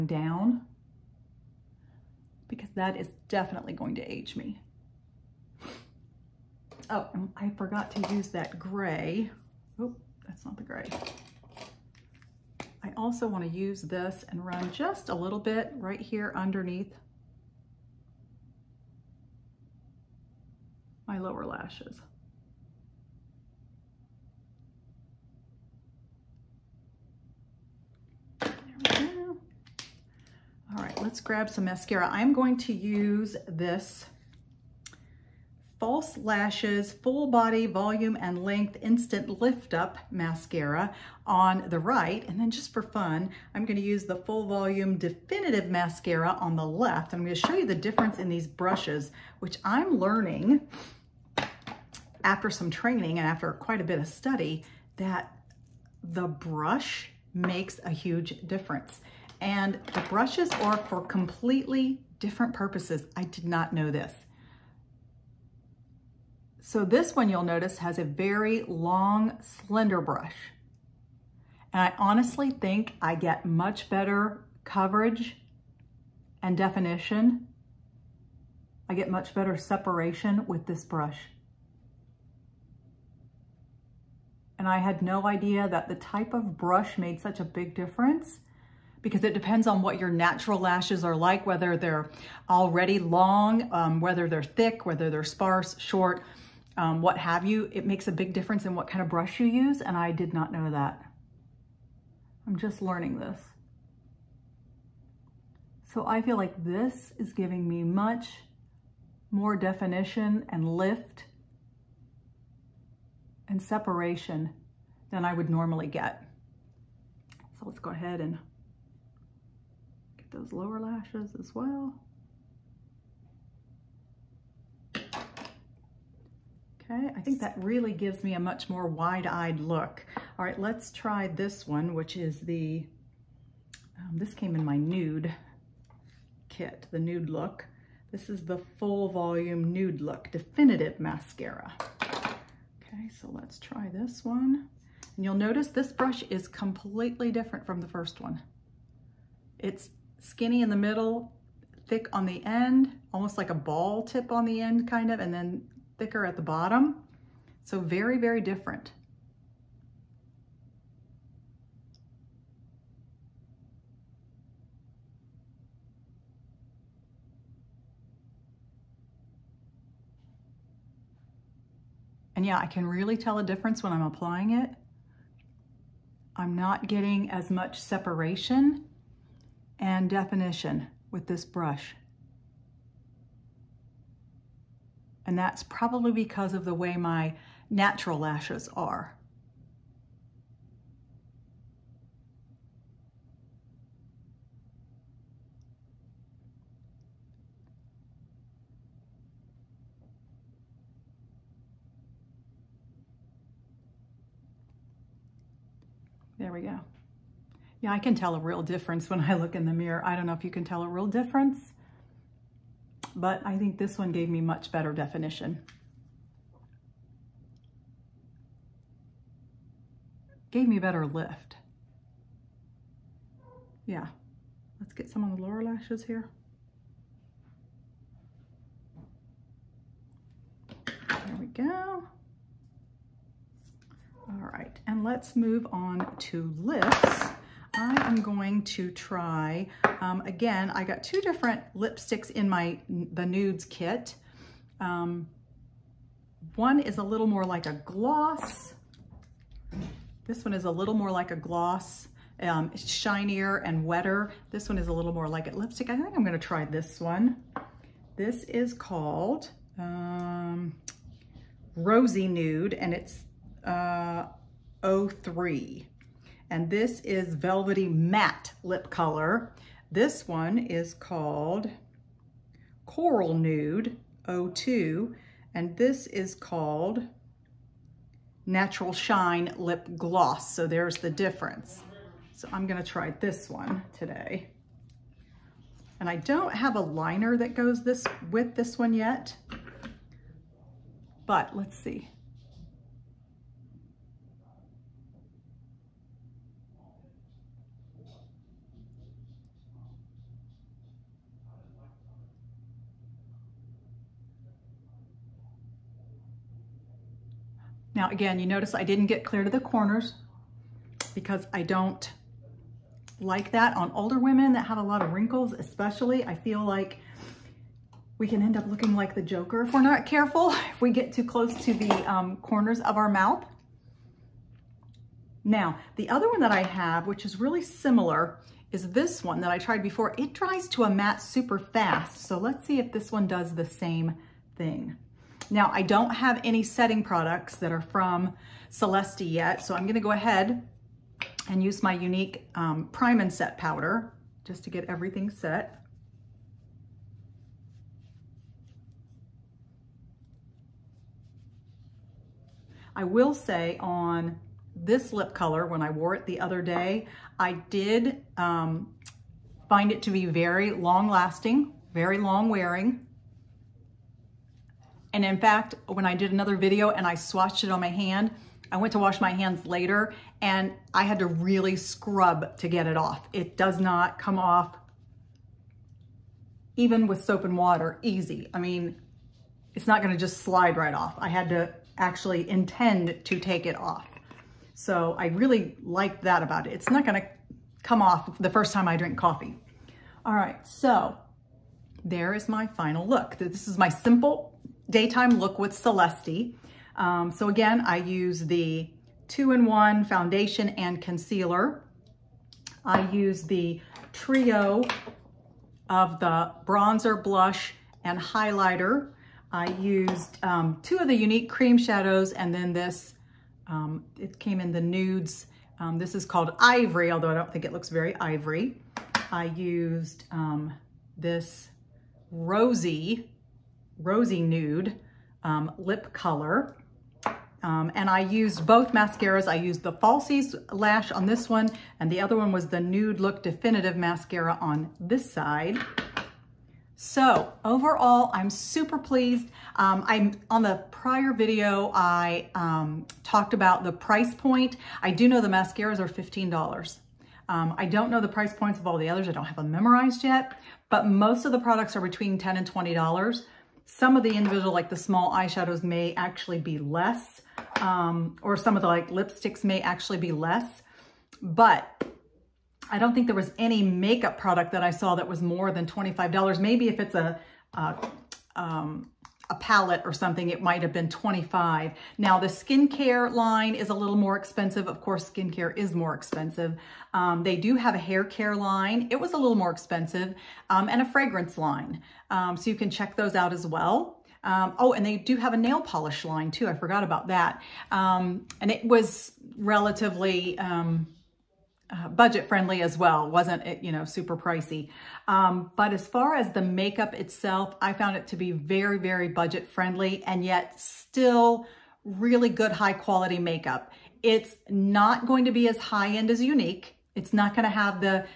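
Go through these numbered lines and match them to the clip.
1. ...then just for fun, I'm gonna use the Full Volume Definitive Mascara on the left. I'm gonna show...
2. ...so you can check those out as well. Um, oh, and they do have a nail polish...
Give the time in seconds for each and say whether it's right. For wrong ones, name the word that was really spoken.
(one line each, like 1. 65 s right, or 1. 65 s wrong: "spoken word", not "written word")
1. 42 s right
2. 482 s right.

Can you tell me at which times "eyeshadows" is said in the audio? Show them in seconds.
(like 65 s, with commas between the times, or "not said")
455 s.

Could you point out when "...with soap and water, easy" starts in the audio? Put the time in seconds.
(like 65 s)
377 s.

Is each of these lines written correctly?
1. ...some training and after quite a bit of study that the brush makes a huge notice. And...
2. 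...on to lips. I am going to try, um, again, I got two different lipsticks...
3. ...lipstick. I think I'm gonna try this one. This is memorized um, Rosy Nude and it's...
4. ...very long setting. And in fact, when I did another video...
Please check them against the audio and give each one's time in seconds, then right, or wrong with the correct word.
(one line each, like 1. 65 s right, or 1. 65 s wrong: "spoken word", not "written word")
1. 52 s wrong: "difference", not "notice"
2. 235 s right
3. 255 s wrong: "called", not "memorized"
4. 361 s wrong: "wearing", not "setting".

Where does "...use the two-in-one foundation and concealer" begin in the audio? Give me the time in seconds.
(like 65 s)
397 s.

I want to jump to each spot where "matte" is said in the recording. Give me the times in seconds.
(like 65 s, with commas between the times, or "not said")
267 s, 330 s.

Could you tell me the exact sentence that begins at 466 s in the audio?
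Maybe if it's a, a um, a palette or something, it might have been 25.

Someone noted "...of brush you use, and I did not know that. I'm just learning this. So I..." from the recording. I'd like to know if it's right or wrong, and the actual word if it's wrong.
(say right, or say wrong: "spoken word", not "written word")
right.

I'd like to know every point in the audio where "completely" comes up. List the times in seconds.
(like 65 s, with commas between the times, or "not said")
61 s, 146 s.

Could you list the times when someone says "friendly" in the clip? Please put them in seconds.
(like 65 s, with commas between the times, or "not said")
492 s, 499 s.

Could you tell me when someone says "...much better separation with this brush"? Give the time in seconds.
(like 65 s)
79 s.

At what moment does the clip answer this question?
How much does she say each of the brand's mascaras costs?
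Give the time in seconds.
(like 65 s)
446 s.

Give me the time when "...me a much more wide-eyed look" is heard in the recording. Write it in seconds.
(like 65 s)
128 s.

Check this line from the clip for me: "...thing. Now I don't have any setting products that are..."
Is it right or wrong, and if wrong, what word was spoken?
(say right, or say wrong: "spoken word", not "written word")
right.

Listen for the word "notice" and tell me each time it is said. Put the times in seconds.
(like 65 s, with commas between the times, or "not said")
67 s, 145 s, 308 s.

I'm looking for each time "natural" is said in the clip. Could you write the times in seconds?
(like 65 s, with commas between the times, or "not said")
90 s, 187 s, 278 s.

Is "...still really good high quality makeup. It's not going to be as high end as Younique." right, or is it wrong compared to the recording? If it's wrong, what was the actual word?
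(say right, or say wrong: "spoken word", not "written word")
right.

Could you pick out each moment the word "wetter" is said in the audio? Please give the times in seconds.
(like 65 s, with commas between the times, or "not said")
253 s.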